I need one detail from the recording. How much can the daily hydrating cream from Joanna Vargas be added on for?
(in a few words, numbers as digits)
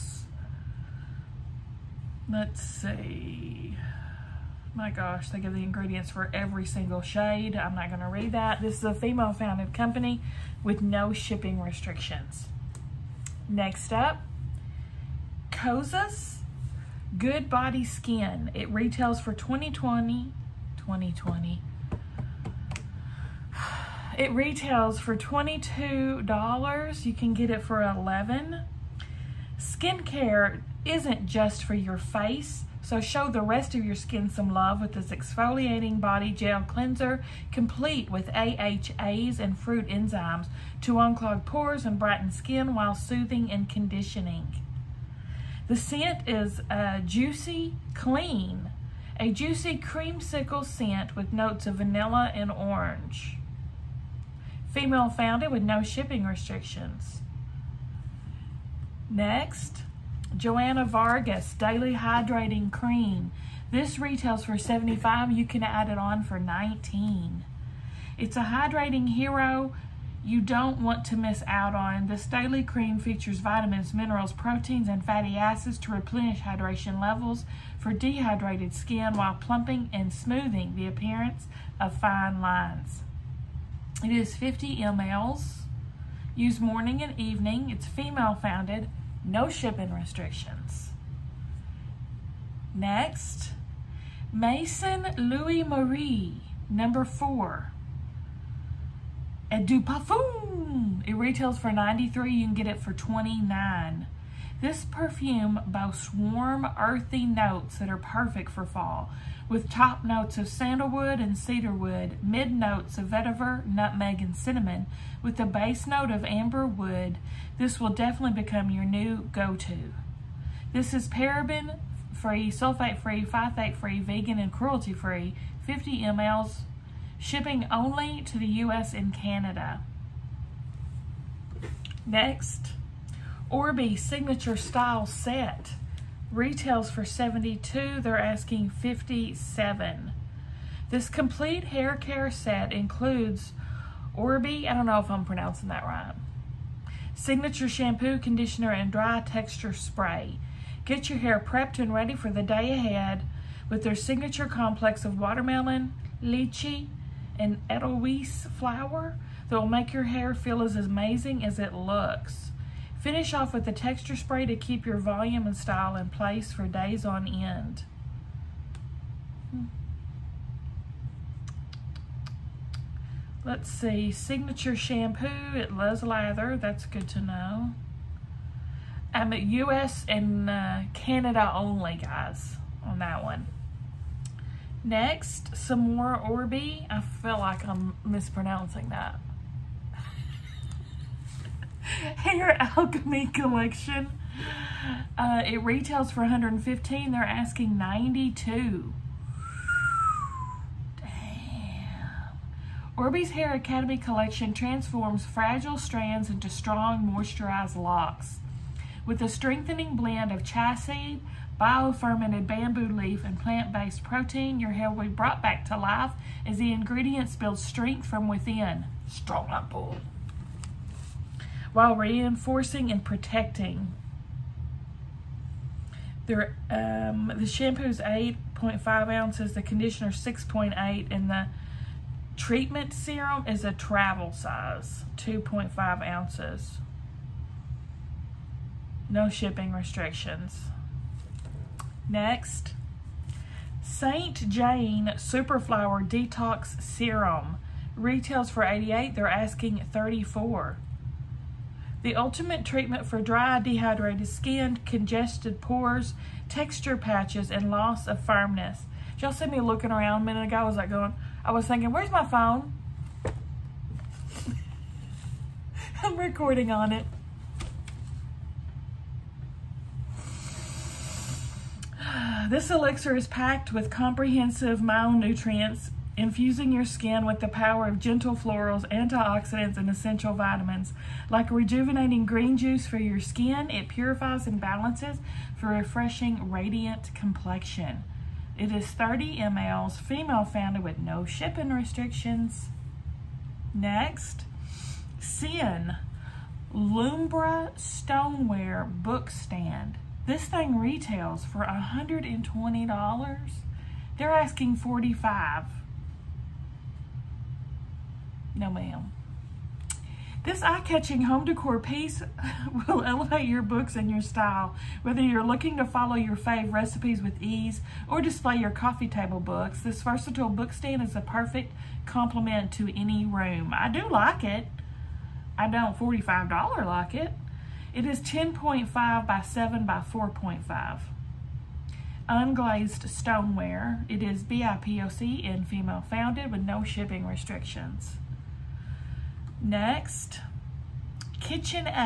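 $19.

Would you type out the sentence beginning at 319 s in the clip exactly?
This versatile book stand is a perfect complement to any room.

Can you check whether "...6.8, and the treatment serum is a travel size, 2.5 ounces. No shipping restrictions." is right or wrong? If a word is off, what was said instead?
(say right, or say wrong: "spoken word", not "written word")
right.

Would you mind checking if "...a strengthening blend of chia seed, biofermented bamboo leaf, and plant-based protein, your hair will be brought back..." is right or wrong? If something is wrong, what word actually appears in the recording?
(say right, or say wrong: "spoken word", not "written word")
right.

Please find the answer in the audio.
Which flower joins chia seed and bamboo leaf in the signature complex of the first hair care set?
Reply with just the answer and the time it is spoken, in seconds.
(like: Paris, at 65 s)
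edelweiss, at 157 s.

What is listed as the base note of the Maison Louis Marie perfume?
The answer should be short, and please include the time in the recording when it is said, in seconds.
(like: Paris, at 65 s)
amber wood, at 116 s.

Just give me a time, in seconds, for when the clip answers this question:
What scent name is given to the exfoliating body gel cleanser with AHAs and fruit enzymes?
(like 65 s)
47 s.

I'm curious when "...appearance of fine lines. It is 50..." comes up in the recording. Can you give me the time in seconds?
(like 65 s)
80 s.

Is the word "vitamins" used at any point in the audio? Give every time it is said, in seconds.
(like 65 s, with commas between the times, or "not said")
73 s, 280 s.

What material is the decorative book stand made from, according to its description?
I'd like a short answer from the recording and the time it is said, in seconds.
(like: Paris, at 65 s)
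Unglazed stoneware, at 332 s.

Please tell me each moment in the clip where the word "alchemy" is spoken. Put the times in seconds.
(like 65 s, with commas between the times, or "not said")
192 s, 203 s.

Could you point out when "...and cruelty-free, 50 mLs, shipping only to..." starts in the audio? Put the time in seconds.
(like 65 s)
124 s.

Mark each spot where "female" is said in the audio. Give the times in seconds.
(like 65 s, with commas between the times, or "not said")
8 s, 54 s, 87 s, 289 s, 335 s.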